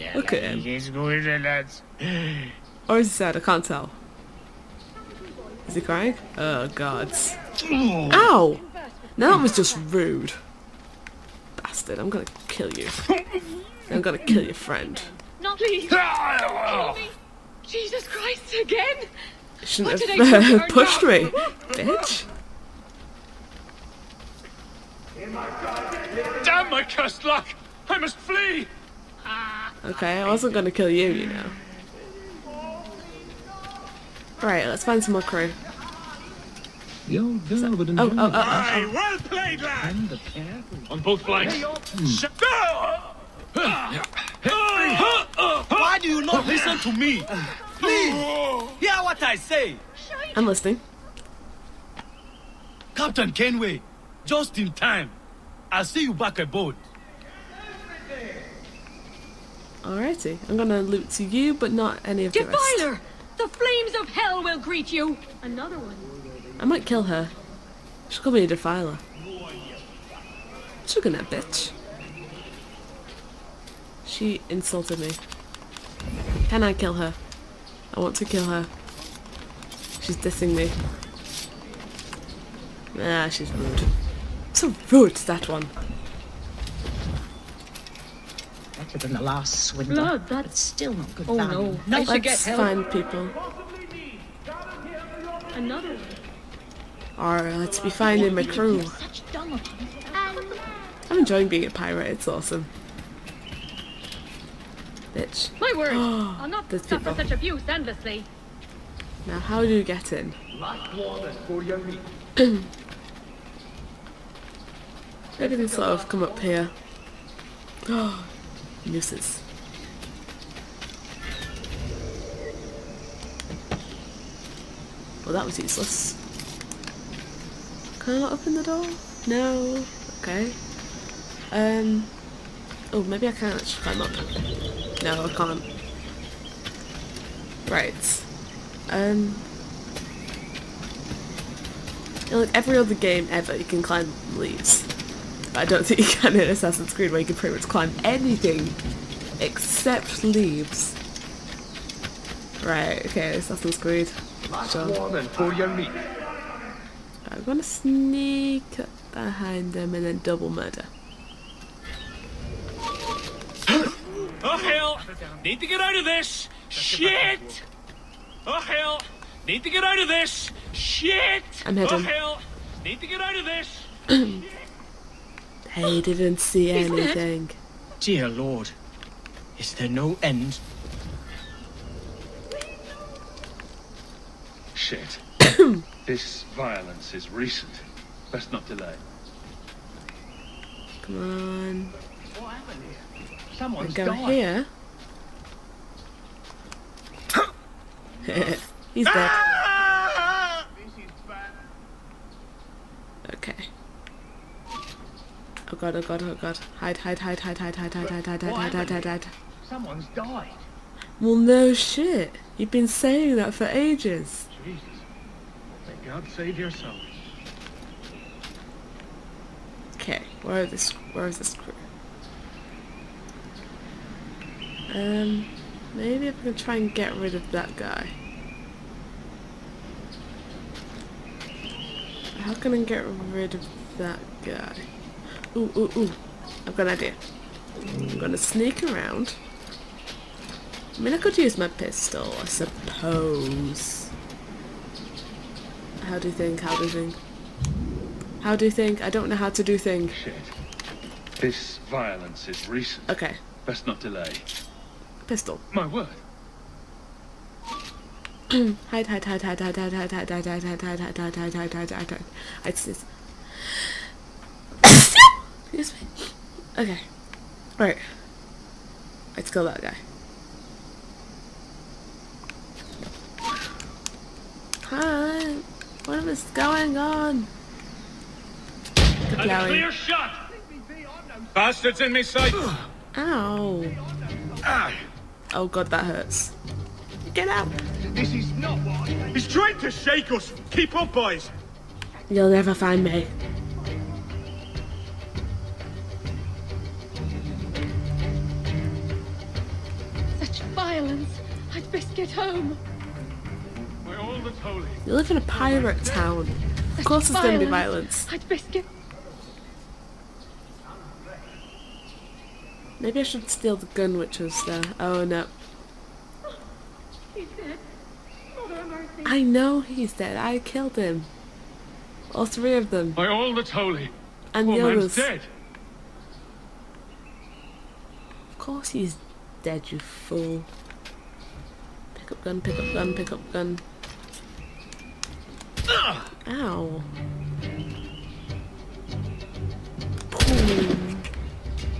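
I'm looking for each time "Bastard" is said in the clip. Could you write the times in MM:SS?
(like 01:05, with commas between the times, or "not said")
00:11, 04:41.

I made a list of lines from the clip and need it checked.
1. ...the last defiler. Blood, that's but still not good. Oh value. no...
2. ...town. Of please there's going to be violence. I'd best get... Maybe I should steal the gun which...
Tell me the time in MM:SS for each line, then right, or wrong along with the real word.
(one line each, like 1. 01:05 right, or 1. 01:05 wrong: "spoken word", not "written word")
1. 01:29 wrong: "swindler", not "defiler"
2. 05:06 wrong: "course", not "please".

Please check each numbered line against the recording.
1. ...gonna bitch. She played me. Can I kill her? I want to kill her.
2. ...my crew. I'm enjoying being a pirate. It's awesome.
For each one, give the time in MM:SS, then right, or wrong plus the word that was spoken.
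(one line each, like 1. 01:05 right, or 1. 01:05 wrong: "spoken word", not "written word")
1. 01:11 wrong: "insulted", not "played"
2. 01:38 right.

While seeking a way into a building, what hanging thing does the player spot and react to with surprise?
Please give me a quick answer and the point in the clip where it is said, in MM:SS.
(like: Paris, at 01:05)
Nooses, at 01:58.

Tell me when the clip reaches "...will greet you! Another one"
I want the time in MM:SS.
01:04.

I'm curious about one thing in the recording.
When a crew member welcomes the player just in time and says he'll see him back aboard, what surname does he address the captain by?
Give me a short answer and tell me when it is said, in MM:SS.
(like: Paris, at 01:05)
Kenway, at 00:53.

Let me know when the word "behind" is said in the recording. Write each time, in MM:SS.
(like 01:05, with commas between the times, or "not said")
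02:39.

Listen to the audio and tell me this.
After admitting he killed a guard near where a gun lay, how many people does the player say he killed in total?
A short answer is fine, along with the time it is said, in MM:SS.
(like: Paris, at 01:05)
3, at 05:22.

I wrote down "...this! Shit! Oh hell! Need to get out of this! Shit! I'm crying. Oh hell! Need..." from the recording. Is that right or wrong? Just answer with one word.
wrong.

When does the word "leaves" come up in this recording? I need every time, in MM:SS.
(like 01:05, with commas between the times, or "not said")
02:24, 02:30.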